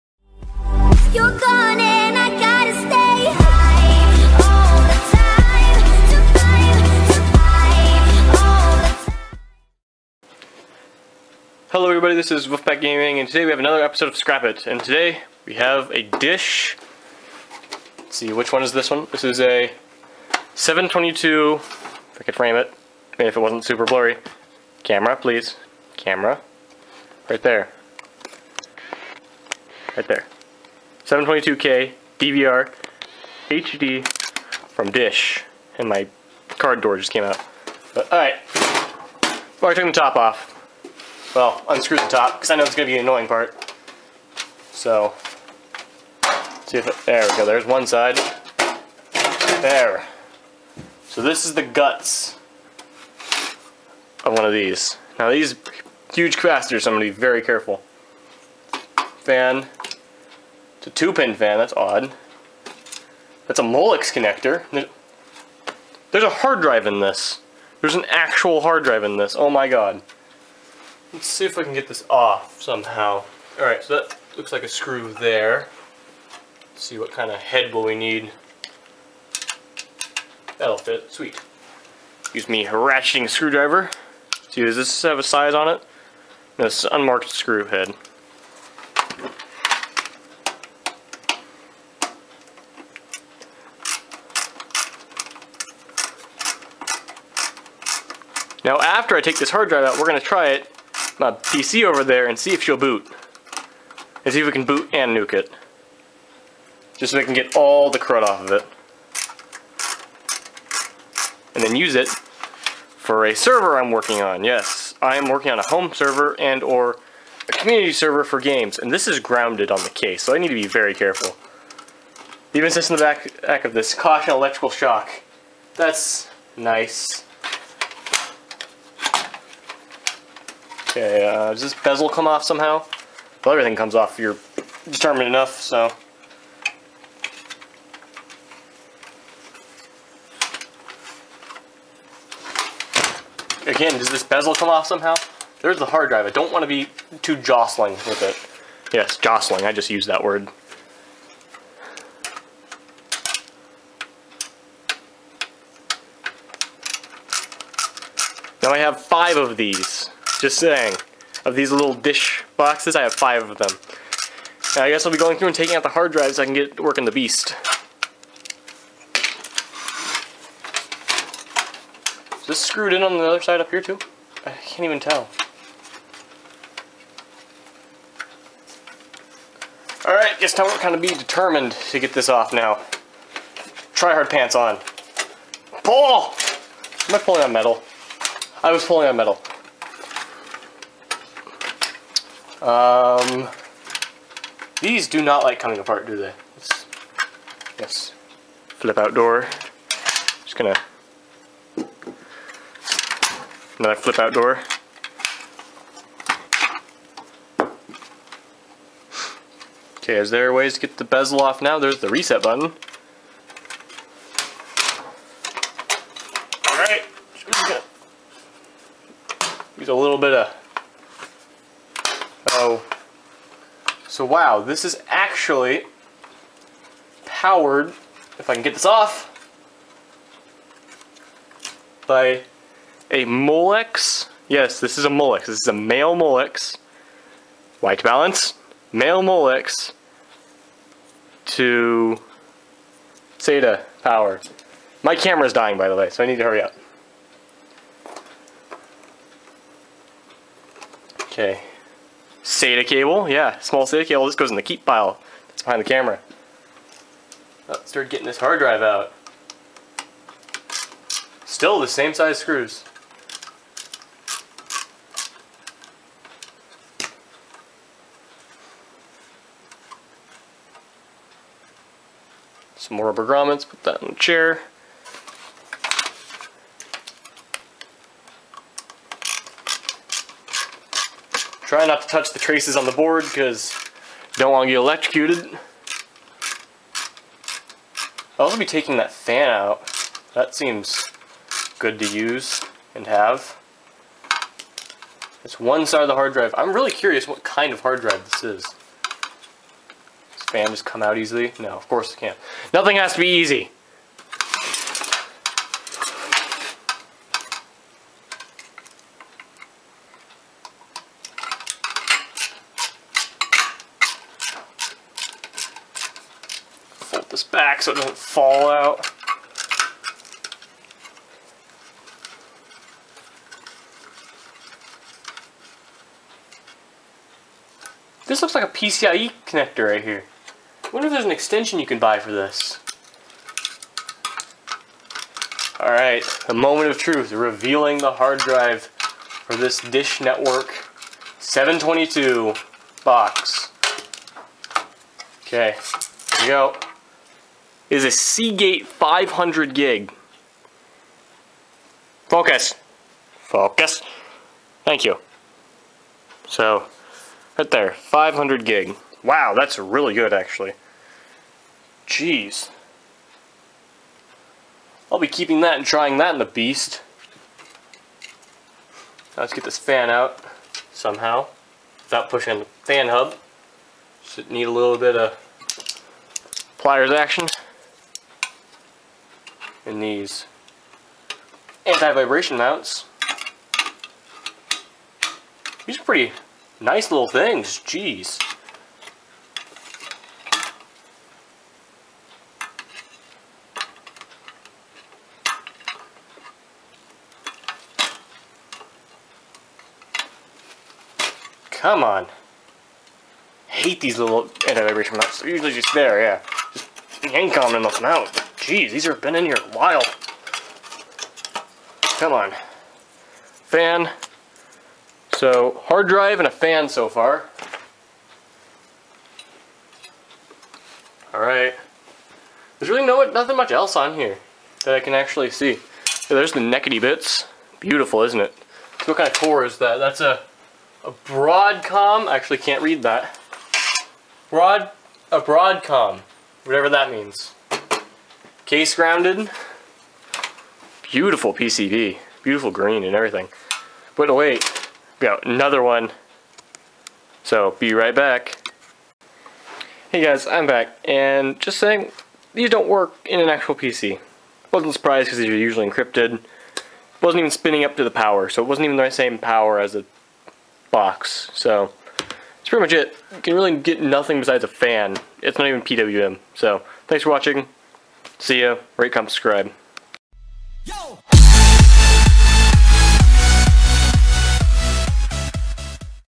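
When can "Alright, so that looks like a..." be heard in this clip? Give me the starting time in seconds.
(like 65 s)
73 s.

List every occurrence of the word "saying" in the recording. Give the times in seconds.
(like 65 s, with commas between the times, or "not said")
160 s, 451 s.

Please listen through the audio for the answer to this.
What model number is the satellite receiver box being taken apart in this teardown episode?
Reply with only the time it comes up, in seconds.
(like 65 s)
31 s.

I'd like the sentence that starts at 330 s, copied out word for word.
I wonder if there's an extension you can buy for this.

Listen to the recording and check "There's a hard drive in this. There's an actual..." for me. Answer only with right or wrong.
right.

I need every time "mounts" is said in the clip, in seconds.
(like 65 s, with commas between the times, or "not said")
382 s, 405 s.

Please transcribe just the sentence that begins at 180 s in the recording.
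Alright, guess time we're kind of be determined to get this off now.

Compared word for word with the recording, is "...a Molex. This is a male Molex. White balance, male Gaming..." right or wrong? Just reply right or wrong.
wrong.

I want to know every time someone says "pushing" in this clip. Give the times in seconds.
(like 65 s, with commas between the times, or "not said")
372 s.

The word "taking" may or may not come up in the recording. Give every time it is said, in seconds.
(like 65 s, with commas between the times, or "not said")
165 s, 288 s.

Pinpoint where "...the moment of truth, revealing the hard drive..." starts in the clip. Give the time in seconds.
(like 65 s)
336 s.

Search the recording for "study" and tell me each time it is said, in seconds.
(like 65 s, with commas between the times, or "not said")
not said.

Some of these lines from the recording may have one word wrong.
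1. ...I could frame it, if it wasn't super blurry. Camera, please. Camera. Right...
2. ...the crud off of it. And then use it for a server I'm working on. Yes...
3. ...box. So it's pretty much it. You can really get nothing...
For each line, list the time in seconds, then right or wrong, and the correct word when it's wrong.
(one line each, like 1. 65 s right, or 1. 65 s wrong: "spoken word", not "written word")
1. 22 s right
2. 107 s right
3. 460 s right.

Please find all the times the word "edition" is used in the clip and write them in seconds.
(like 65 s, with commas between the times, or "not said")
not said.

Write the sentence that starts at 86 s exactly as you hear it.
No, this is unmarked screw head.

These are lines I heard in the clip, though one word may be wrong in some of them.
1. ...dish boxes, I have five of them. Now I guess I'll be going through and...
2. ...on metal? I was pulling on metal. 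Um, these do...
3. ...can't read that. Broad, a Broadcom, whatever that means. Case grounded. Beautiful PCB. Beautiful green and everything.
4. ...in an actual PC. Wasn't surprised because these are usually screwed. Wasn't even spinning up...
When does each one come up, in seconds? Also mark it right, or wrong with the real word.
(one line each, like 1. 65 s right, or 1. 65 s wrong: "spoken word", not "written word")
1. 161 s right
2. 187 s right
3. 432 s right
4. 453 s wrong: "encrypted", not "screwed".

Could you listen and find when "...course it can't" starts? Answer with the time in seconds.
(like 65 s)
301 s.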